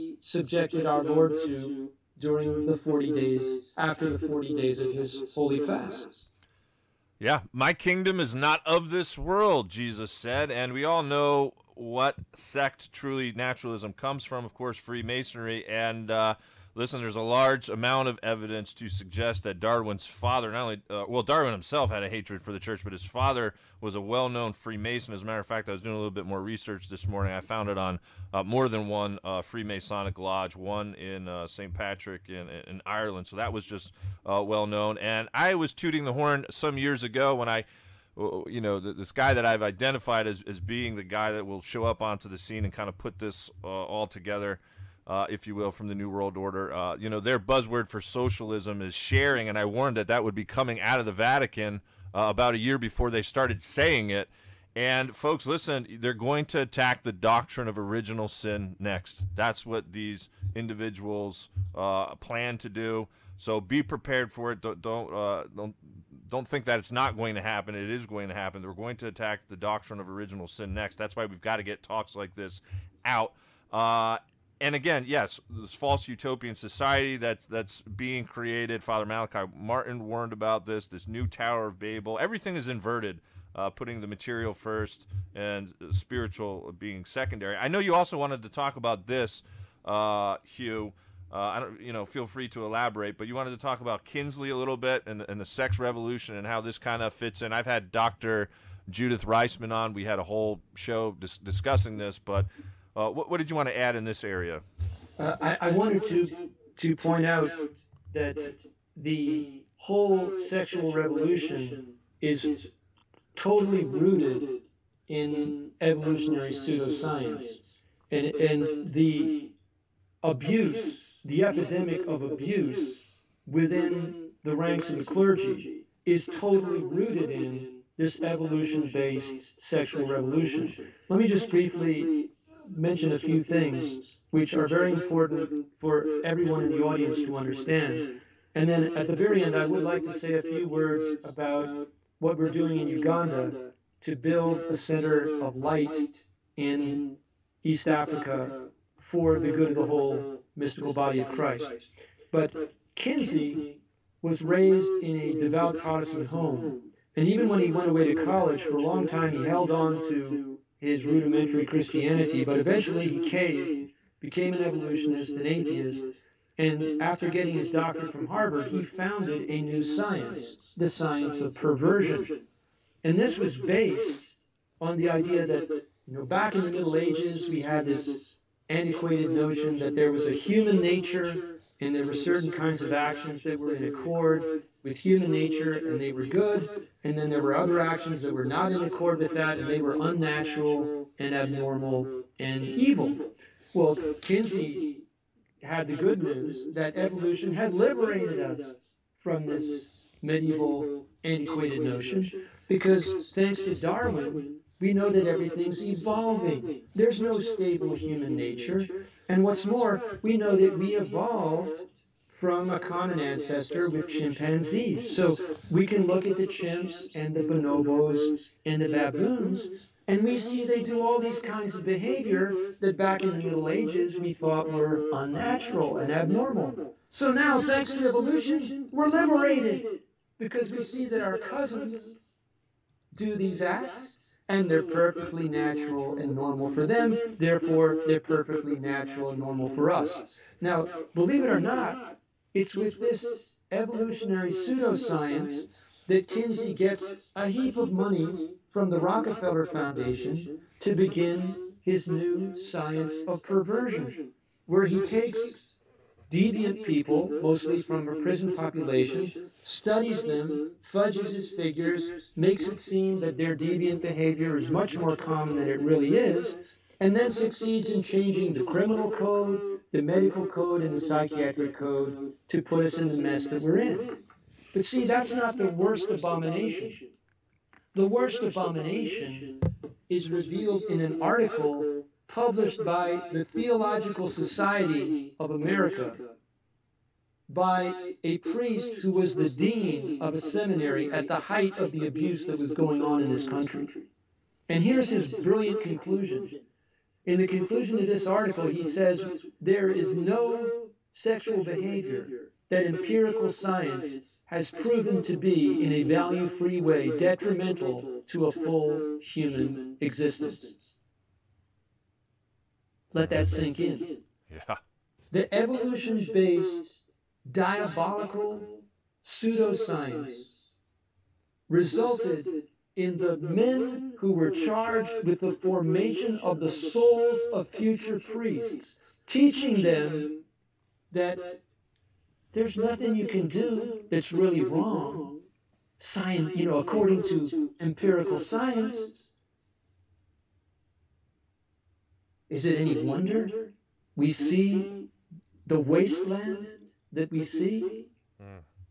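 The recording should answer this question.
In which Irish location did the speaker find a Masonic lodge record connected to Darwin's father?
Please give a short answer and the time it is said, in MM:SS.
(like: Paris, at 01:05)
St. Patrick, at 00:31.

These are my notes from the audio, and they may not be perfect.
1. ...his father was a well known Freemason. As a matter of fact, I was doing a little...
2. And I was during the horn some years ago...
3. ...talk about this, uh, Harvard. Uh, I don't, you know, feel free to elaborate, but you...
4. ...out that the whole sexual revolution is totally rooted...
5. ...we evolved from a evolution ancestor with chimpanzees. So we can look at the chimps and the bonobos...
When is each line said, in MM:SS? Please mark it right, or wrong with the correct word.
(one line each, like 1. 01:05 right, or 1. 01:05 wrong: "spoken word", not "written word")
1. 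00:22 right
2. 00:34 wrong: "tooting", not "during"
3. 01:28 wrong: "Hugh", not "Harvard"
4. 01:47 right
5. 03:30 wrong: "common", not "evolution".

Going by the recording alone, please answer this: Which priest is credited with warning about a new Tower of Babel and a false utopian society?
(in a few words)
Malachi Martin.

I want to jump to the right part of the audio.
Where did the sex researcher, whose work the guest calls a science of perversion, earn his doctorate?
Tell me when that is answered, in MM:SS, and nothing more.
02:48.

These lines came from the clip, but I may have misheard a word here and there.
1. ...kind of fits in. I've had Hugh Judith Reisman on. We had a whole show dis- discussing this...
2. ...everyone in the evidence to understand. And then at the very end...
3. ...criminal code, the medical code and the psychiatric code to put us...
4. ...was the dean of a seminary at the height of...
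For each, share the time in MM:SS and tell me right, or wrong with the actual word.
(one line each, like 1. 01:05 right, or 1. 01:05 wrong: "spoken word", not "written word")
1. 01:36 wrong: "Doctor", not "Hugh"
2. 02:16 wrong: "audience", not "evidence"
3. 04:28 right
4. 04:49 right.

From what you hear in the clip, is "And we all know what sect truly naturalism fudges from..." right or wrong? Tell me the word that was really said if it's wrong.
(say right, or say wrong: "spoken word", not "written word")
wrong: "comes", not "fudges".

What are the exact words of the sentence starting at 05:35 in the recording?
Science, you know, according to empirical science, is it any wonder we see the wasteland that we see?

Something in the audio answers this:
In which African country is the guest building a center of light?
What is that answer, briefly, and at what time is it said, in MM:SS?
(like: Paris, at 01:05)
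Uganda, at 02:22.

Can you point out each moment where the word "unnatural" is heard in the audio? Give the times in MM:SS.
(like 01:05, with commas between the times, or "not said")
03:10, 03:45.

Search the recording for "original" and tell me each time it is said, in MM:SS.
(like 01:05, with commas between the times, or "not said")
00:57, 01:10.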